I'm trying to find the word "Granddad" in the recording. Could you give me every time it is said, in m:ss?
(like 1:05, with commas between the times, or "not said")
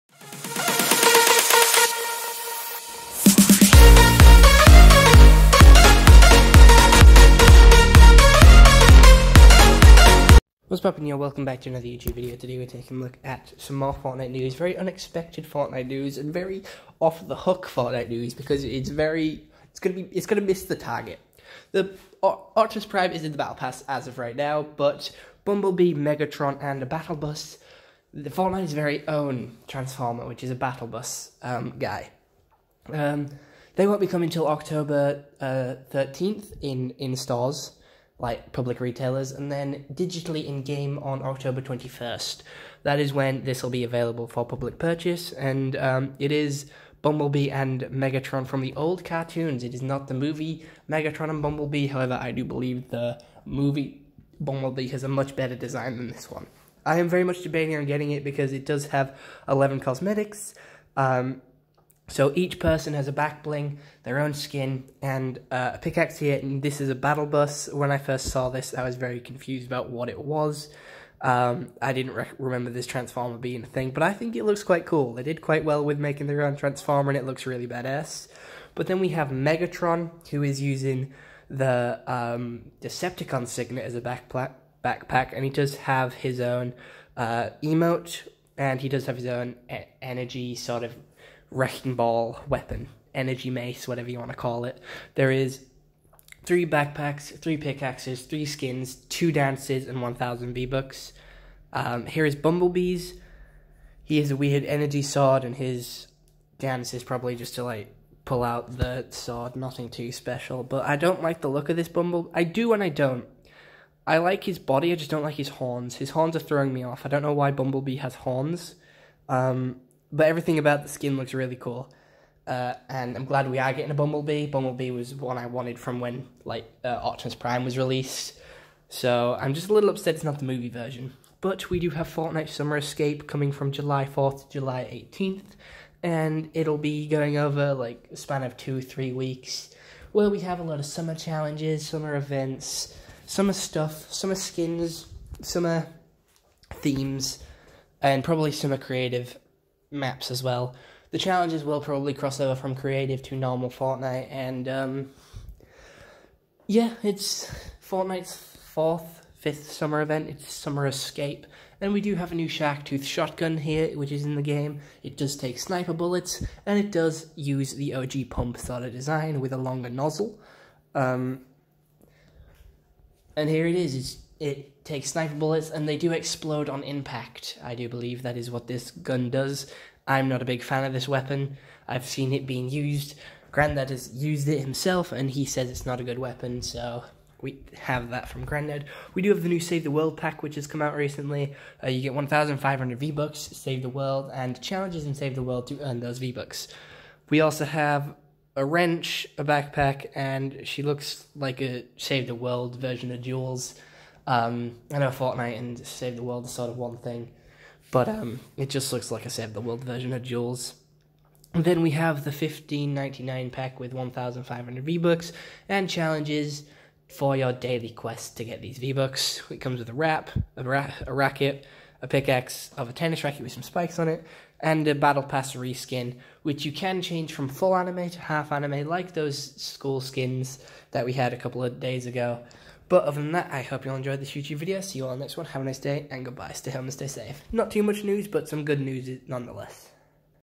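3:03, 3:08.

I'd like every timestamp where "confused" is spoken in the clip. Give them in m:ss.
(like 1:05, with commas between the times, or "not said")
1:09.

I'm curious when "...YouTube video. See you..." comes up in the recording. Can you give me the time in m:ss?
3:54.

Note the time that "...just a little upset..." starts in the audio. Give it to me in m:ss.
2:09.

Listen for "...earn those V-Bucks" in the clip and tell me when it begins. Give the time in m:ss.
3:15.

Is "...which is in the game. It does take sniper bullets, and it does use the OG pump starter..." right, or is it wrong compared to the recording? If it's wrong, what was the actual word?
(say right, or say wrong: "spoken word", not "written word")
right.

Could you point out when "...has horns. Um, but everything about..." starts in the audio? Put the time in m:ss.
1:57.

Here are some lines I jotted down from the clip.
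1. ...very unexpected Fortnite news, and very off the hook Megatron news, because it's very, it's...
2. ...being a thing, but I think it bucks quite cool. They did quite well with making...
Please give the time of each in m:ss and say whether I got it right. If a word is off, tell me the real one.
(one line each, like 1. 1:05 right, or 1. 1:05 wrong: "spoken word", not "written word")
1. 0:14 wrong: "Fortnite", not "Megatron"
2. 1:13 wrong: "looks", not "bucks".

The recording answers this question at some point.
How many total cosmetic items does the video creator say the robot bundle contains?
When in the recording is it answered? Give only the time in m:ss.
0:59.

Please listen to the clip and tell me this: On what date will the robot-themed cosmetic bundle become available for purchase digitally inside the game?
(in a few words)
October 21st.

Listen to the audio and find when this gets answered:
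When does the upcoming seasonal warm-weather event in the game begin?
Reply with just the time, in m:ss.
2:13.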